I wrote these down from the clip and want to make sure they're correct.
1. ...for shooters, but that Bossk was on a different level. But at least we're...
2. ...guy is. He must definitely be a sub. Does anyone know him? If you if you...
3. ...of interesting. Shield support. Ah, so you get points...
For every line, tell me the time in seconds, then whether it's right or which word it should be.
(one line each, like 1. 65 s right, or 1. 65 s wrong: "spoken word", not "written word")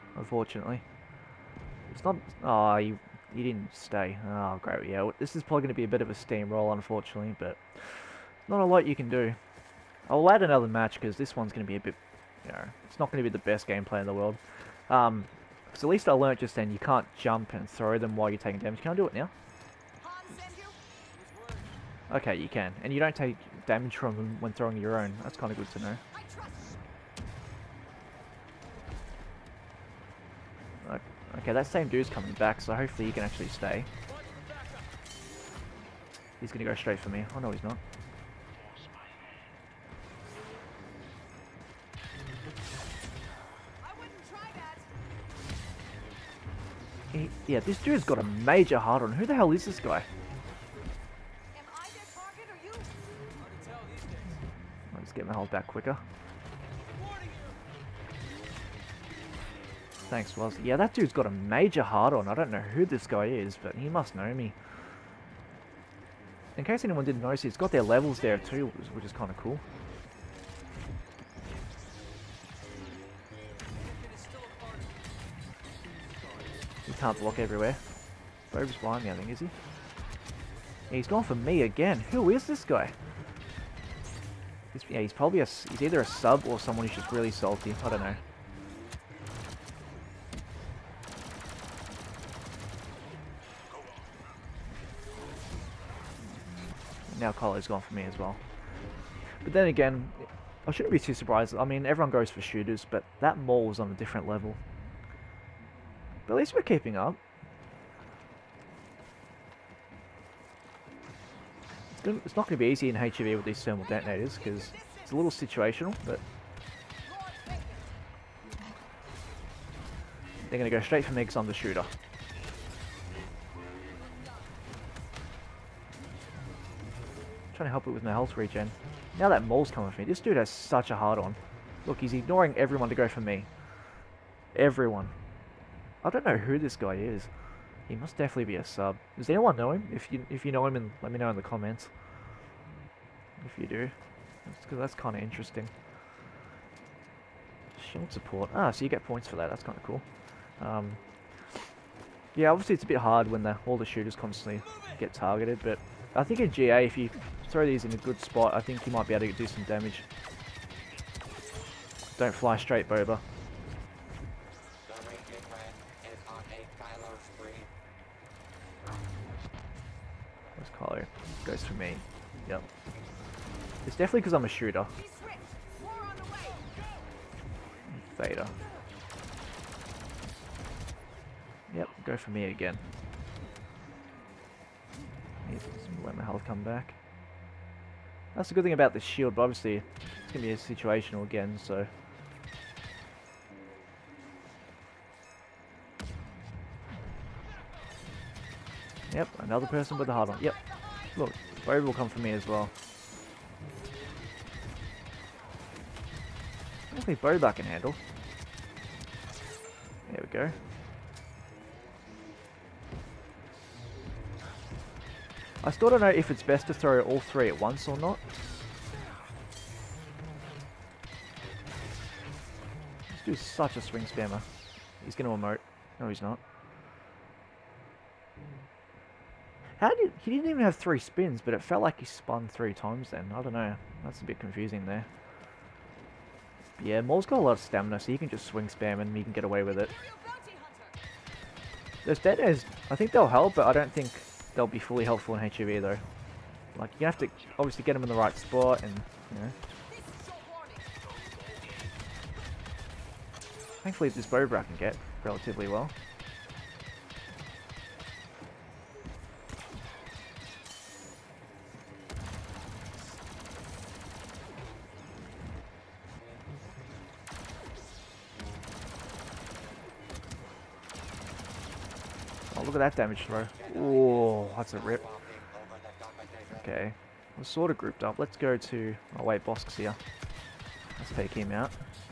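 1. 102 s wrong: "Maul", not "Bossk"
2. 136 s right
3. 145 s right.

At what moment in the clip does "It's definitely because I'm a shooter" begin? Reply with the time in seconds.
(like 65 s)
173 s.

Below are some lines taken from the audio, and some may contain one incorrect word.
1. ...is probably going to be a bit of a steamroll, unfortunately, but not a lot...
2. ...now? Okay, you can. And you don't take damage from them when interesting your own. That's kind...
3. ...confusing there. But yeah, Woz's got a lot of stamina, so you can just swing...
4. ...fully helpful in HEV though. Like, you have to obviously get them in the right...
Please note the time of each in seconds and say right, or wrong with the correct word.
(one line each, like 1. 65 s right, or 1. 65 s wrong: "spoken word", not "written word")
1. 5 s right
2. 19 s wrong: "throwing", not "interesting"
3. 234 s wrong: "Maul", not "Woz"
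4. 244 s right.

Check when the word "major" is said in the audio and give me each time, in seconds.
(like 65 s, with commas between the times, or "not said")
48 s, 61 s.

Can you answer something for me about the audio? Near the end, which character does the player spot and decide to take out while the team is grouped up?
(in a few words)
Bossk.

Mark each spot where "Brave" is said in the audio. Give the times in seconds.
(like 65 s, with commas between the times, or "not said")
201 s.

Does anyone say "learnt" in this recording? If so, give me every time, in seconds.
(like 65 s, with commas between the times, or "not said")
16 s.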